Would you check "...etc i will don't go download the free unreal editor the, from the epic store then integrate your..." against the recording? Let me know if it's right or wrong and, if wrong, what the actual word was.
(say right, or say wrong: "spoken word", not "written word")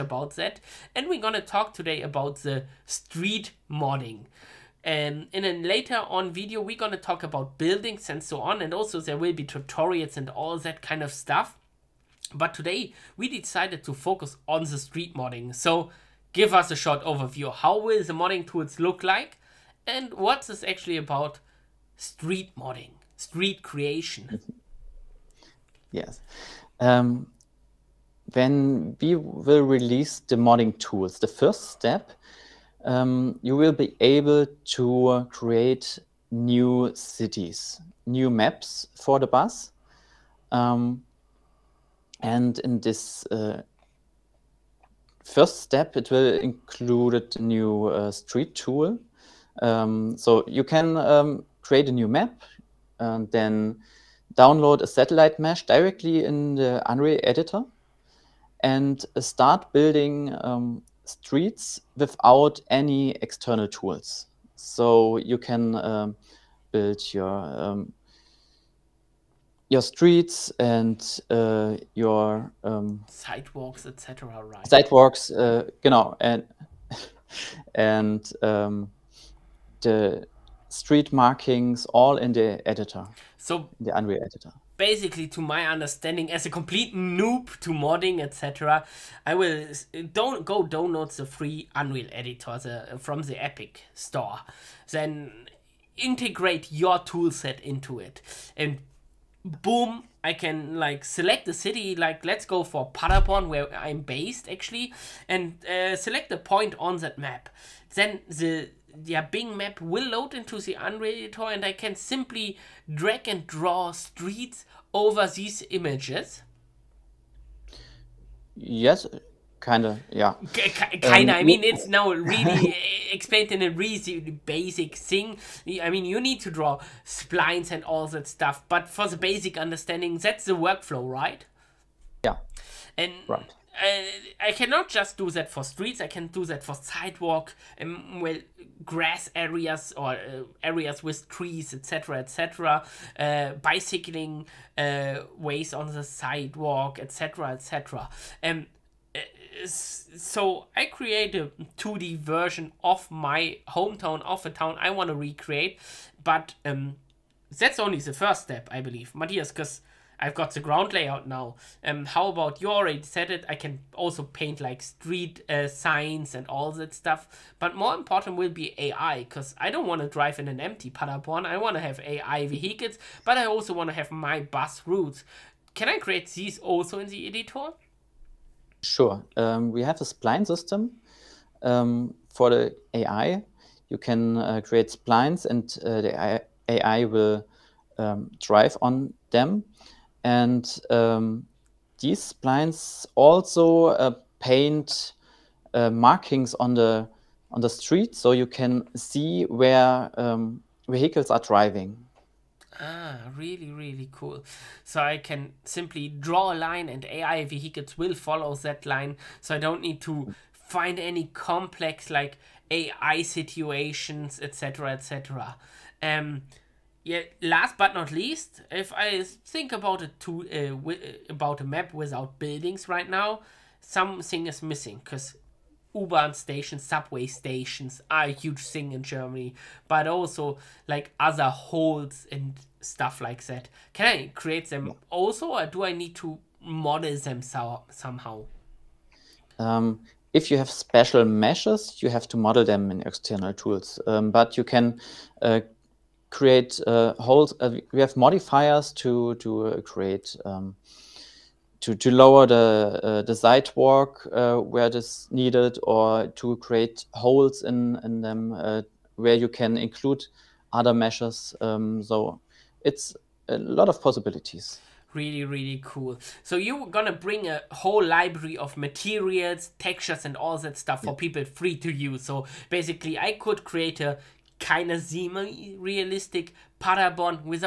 right.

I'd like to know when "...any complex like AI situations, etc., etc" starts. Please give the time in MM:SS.
03:30.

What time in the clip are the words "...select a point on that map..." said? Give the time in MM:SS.
01:45.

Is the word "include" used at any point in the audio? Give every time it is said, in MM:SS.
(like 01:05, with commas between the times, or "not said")
00:46, 04:19.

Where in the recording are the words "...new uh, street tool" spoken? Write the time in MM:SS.
00:47.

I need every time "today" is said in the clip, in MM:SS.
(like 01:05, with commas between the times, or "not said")
00:01, 00:12.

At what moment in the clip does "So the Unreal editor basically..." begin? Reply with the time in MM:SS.
01:23.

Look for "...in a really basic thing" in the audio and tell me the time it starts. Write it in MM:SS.
02:03.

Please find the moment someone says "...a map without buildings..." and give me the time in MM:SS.
03:41.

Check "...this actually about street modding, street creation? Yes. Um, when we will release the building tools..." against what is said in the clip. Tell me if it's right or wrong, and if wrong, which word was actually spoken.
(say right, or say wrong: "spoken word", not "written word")
wrong: "modding", not "building".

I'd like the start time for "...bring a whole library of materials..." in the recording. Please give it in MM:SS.
04:27.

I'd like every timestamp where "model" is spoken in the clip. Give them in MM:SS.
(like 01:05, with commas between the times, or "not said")
03:56, 04:02.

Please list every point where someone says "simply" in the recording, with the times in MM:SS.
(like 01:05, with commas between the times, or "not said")
01:51, 03:25.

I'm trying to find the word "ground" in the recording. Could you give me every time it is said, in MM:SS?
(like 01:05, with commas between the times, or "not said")
02:40.